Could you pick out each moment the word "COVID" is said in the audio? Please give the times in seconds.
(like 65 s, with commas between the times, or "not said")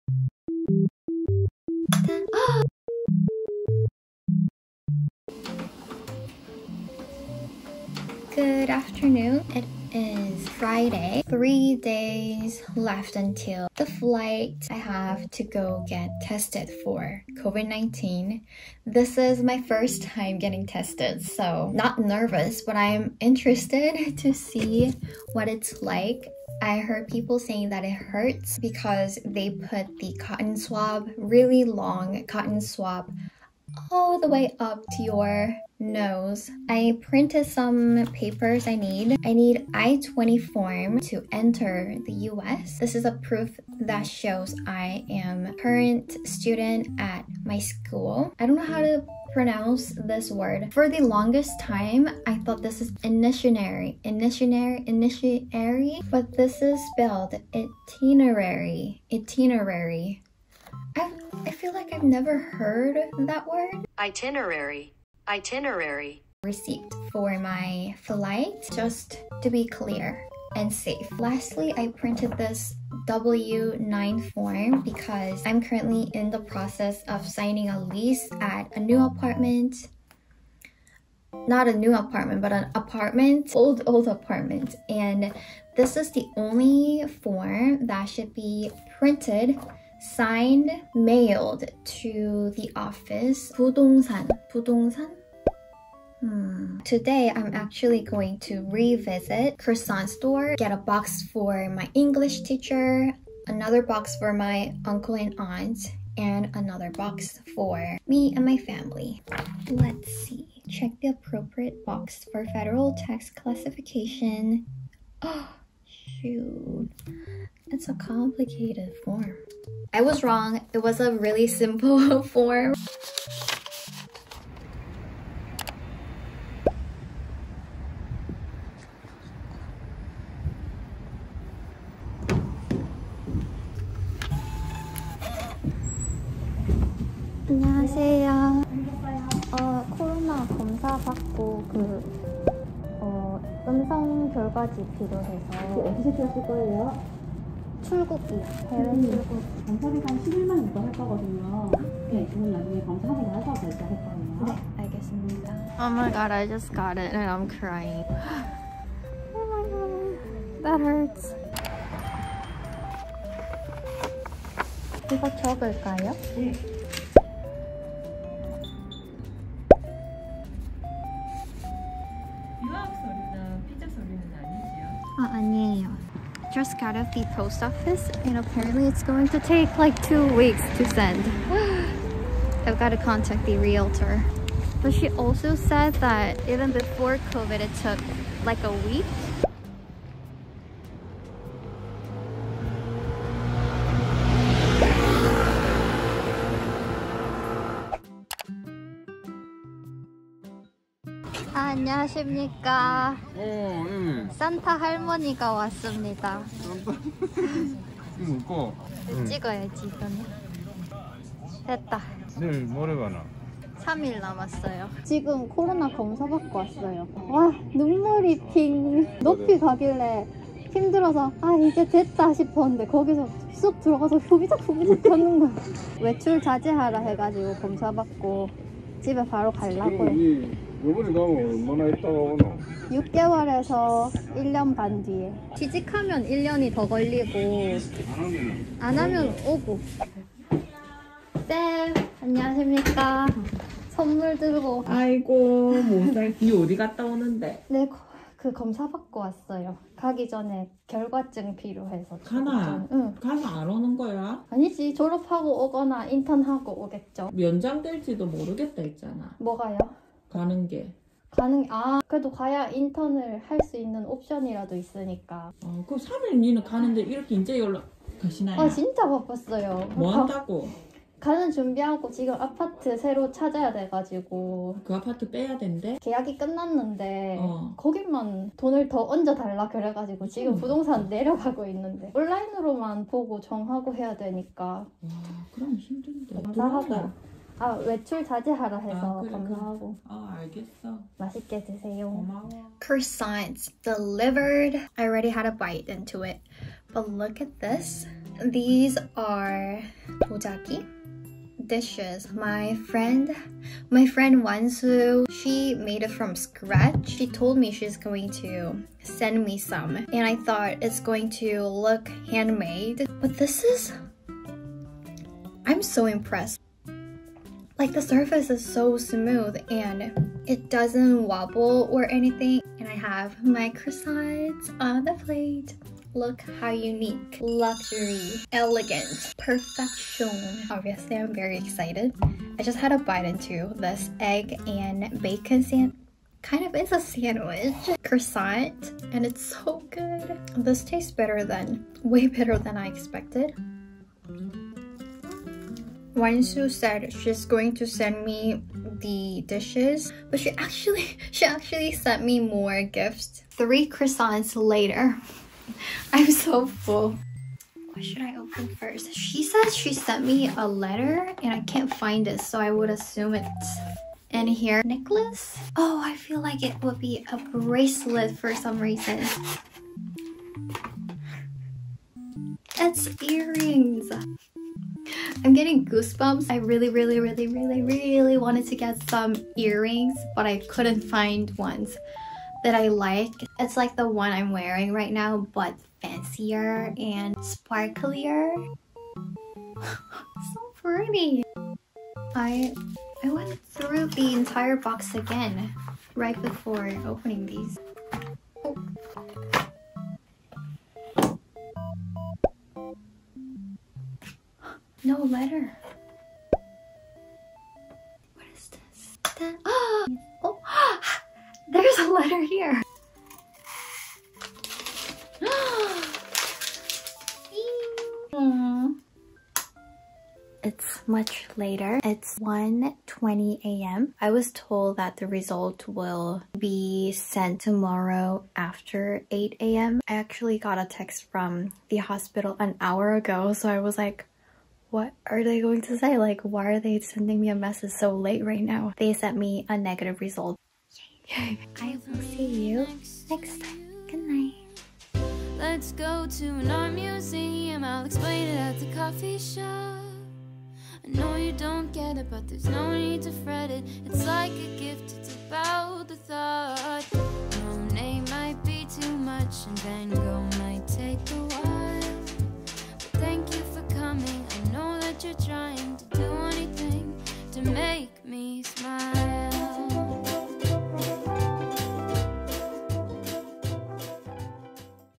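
17 s, 187 s.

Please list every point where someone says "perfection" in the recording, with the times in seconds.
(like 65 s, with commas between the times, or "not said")
329 s.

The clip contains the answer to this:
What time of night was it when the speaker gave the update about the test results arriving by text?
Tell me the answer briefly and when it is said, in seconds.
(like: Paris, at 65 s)
1:20 a.m., at 422 s.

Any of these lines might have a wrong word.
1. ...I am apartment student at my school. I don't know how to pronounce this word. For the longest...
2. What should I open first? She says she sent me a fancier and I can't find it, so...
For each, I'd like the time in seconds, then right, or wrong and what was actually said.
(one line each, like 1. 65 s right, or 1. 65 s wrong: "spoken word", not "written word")
1. 44 s wrong: "current", not "apartment"
2. 357 s wrong: "letter", not "fancier".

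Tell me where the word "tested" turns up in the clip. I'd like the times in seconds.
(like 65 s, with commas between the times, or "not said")
16 s, 20 s.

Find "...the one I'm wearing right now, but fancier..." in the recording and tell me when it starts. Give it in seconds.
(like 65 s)
383 s.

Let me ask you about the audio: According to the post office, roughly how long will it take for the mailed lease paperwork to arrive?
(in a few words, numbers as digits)
2 weeks.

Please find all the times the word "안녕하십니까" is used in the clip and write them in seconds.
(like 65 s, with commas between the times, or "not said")
201 s, 242 s.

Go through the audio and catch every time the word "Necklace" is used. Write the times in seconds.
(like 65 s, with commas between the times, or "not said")
364 s.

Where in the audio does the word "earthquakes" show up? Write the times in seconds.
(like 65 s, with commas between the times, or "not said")
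not said.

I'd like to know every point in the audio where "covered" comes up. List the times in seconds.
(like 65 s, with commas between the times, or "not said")
not said.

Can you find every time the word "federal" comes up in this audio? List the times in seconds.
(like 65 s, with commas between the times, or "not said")
112 s.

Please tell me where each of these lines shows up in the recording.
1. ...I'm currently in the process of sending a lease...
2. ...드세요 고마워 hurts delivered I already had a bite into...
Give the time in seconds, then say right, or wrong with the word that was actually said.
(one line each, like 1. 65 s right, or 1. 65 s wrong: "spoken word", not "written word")
1. 75 s wrong: "signing", not "sending"
2. 291 s wrong: "croissants", not "hurts".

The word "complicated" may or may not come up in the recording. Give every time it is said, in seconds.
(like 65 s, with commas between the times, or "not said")
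117 s.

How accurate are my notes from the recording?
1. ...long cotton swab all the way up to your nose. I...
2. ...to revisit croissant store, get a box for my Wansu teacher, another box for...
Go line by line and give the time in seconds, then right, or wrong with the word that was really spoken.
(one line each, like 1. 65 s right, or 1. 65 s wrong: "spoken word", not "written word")
1. 31 s right
2. 98 s wrong: "English", not "Wansu".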